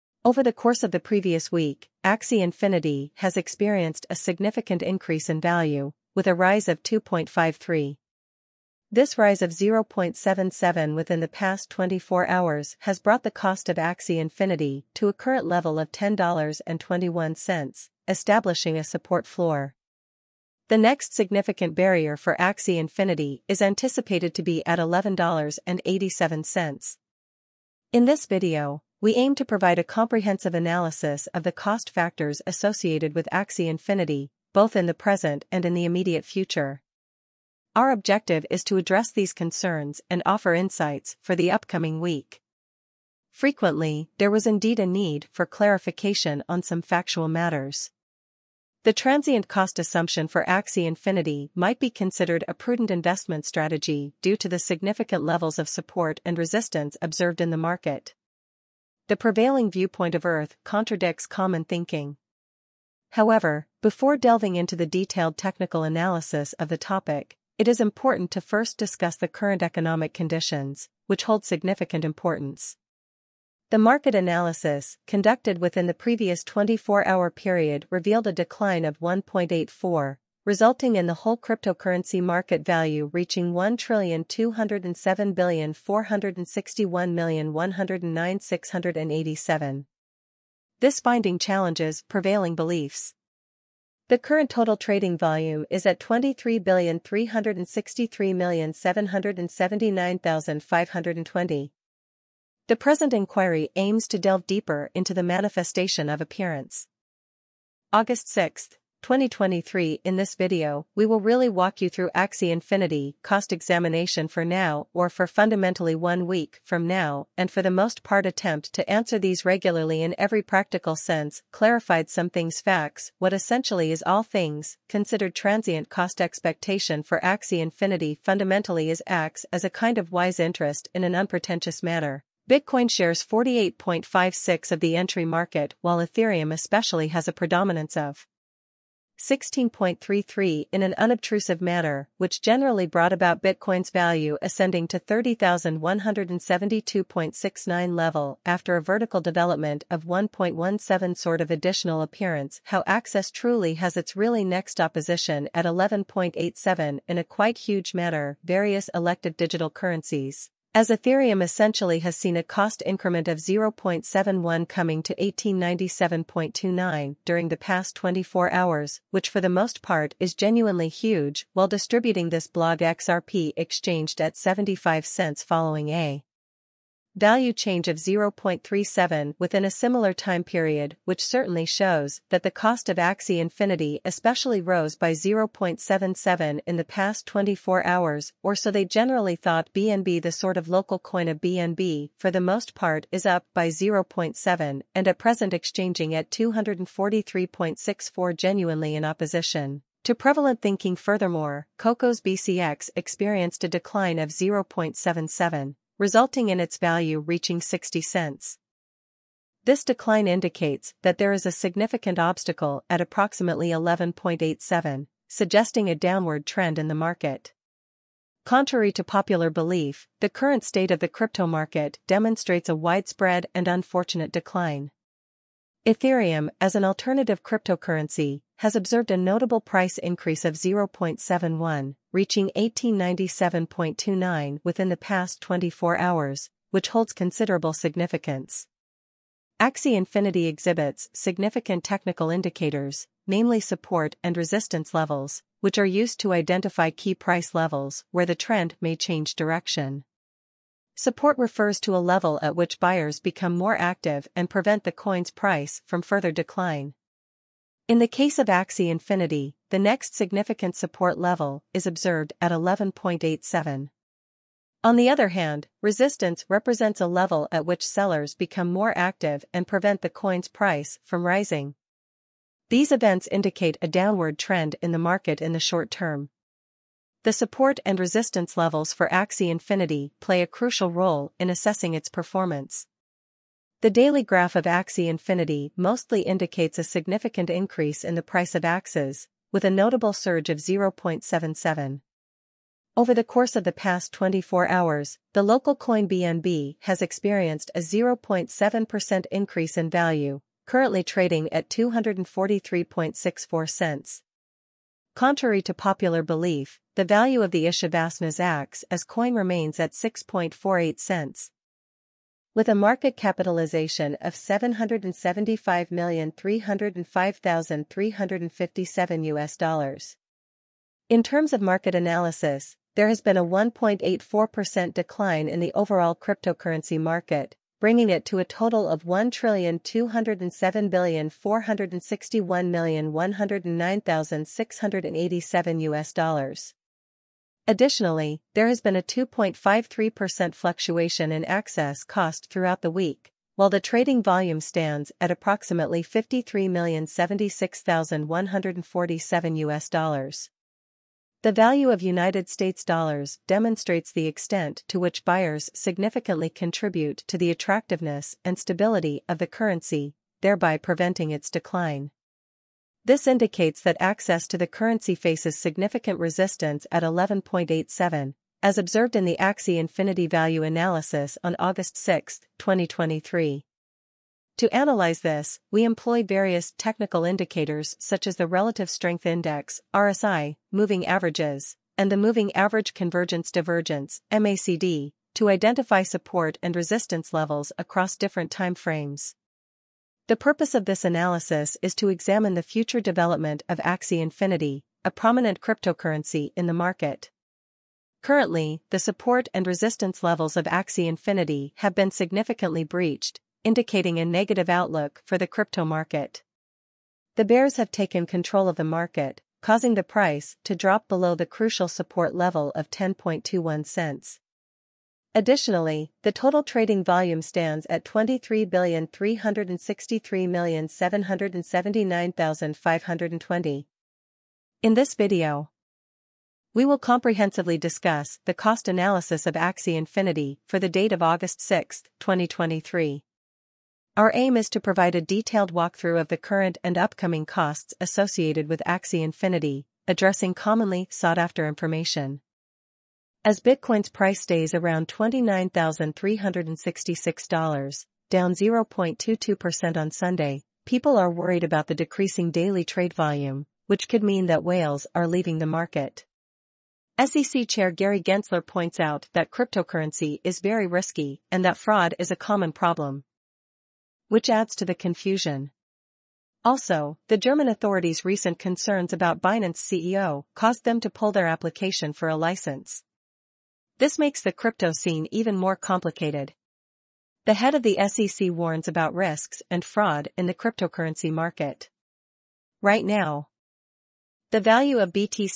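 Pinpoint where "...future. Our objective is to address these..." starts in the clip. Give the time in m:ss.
0:36.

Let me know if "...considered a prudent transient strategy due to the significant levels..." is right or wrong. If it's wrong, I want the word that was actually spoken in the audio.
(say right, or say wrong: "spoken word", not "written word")
wrong: "investment", not "transient".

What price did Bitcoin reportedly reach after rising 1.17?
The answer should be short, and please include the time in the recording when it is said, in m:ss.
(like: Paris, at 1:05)
30,172.69, at 2:24.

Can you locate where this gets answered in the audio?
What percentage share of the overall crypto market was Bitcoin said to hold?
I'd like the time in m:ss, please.
2:13.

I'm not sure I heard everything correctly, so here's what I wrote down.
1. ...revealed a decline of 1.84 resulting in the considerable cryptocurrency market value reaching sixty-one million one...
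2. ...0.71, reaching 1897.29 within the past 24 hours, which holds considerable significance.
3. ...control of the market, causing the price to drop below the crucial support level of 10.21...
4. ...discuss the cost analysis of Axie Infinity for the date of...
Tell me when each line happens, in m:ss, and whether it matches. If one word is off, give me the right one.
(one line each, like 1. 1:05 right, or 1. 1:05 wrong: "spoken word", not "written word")
1. 1:17 wrong: "whole", not "considerable"
2. 3:50 right
3. 6:48 right
4. 7:07 right.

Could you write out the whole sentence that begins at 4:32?
These events indicate a downward trend in the market in the short term.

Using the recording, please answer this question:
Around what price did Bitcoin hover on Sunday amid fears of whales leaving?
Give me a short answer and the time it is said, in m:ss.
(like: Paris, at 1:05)
$29,366, at 7:25.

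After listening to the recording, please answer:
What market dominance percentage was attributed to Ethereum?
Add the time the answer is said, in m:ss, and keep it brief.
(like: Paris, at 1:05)
16.33, at 2:19.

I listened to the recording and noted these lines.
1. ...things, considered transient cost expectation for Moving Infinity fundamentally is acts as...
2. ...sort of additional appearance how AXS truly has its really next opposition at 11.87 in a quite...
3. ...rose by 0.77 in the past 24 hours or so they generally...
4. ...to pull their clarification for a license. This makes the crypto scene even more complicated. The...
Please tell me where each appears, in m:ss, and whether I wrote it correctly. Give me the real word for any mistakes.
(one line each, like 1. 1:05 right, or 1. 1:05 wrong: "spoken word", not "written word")
1. 2:04 wrong: "Axie", not "Moving"
2. 2:31 right
3. 3:04 right
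4. 7:50 wrong: "application", not "clarification".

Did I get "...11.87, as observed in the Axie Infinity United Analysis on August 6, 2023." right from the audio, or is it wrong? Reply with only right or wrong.
wrong.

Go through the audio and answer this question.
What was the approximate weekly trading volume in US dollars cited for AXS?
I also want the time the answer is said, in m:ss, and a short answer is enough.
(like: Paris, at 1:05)
53,076,147, at 5:46.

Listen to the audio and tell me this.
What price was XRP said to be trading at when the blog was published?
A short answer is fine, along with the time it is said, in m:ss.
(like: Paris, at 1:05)
75 cents, at 2:54.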